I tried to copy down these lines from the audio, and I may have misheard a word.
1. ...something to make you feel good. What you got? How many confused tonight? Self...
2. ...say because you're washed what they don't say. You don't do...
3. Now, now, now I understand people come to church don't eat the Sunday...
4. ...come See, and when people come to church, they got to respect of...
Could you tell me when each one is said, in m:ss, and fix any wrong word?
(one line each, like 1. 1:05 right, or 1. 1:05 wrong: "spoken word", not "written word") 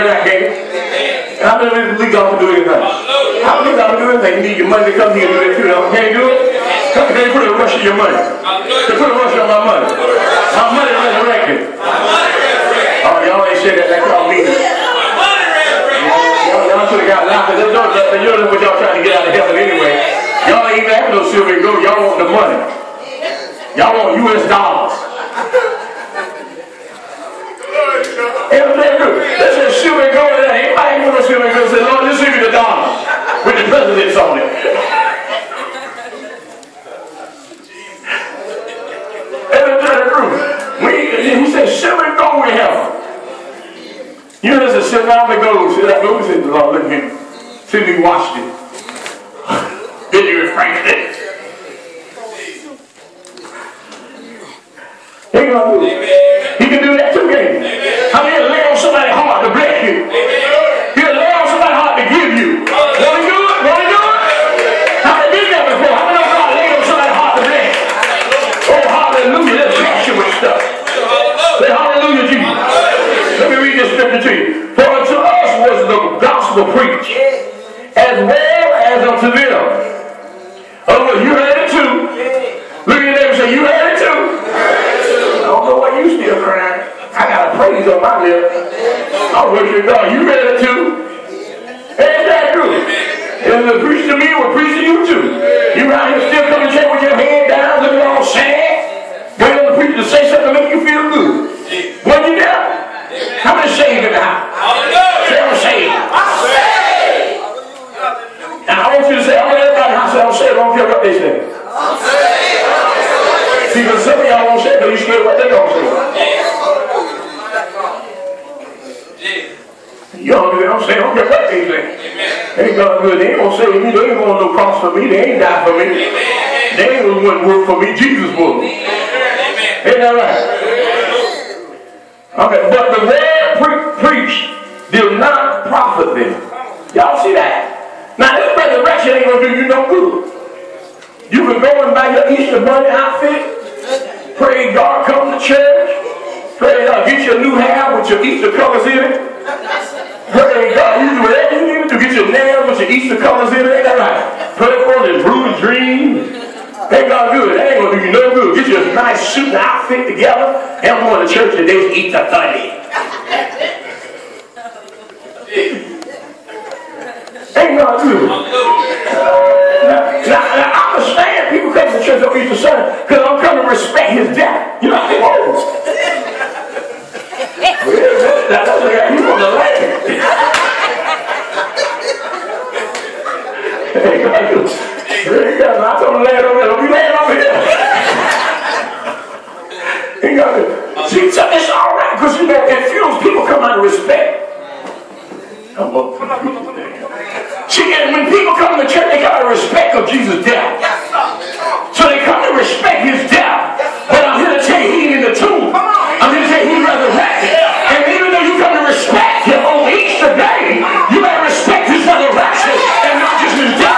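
1. 1:40 wrong: "saved", not "confused"
2. 1:54 wrong: "scared", not "washed"
3. 2:48 right
4. 3:16 right.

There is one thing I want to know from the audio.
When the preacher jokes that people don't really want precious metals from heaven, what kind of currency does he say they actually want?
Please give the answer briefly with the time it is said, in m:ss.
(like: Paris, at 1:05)
U.S. dollars, at 0:24.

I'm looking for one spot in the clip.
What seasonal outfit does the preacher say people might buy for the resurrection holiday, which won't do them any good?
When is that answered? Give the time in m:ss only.
2:22.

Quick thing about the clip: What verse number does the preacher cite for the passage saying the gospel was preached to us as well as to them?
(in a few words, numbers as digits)
17.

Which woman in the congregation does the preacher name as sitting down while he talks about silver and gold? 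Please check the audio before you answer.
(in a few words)
Eunice.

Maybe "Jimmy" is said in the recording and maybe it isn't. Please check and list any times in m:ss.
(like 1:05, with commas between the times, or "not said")
not said.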